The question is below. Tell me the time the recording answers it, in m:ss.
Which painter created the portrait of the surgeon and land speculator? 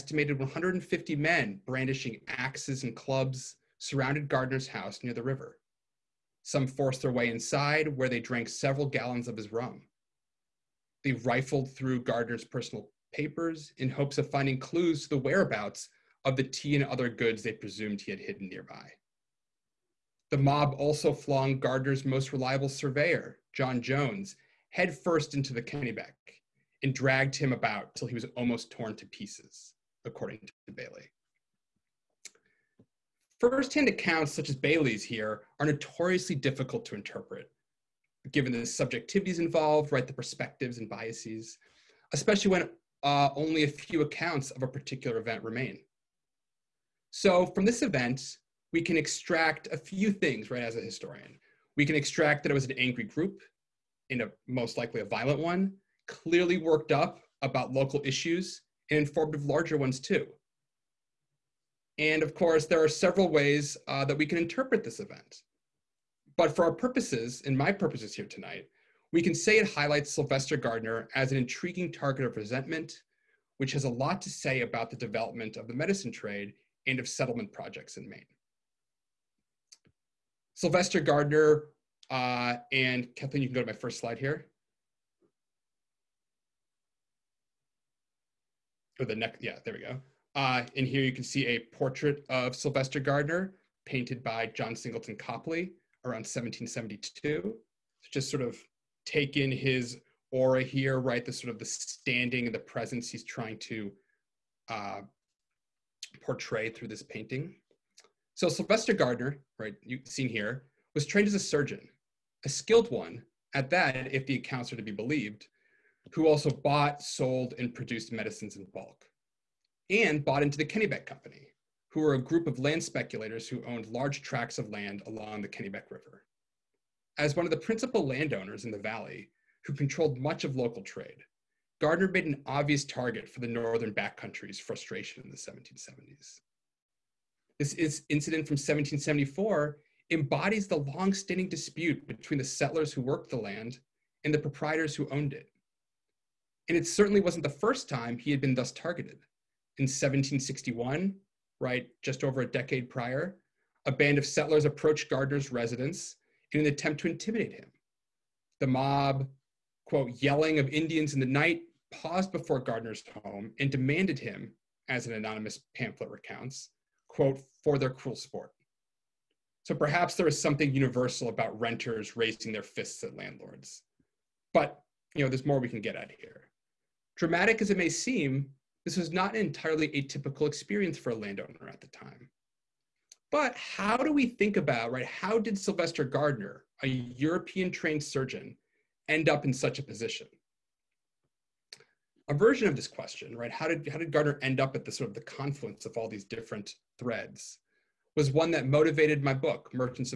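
1:34.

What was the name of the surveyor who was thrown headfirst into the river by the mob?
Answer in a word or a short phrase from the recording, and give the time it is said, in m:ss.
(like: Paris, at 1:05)
John Jones, at 0:23.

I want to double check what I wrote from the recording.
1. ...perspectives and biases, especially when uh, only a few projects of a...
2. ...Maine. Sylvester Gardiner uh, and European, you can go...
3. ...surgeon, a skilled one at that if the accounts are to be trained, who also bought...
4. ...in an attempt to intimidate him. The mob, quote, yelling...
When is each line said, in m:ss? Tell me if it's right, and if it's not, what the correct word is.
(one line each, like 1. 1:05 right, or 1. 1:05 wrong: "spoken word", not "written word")
1. 0:40 wrong: "accounts", not "projects"
2. 1:18 wrong: "Kathleen", not "European"
3. 1:51 wrong: "believed", not "trained"
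4. 2:36 right.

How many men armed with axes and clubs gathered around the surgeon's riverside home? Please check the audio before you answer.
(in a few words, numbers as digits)
150.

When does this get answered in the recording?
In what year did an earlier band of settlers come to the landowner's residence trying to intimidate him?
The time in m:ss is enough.
2:29.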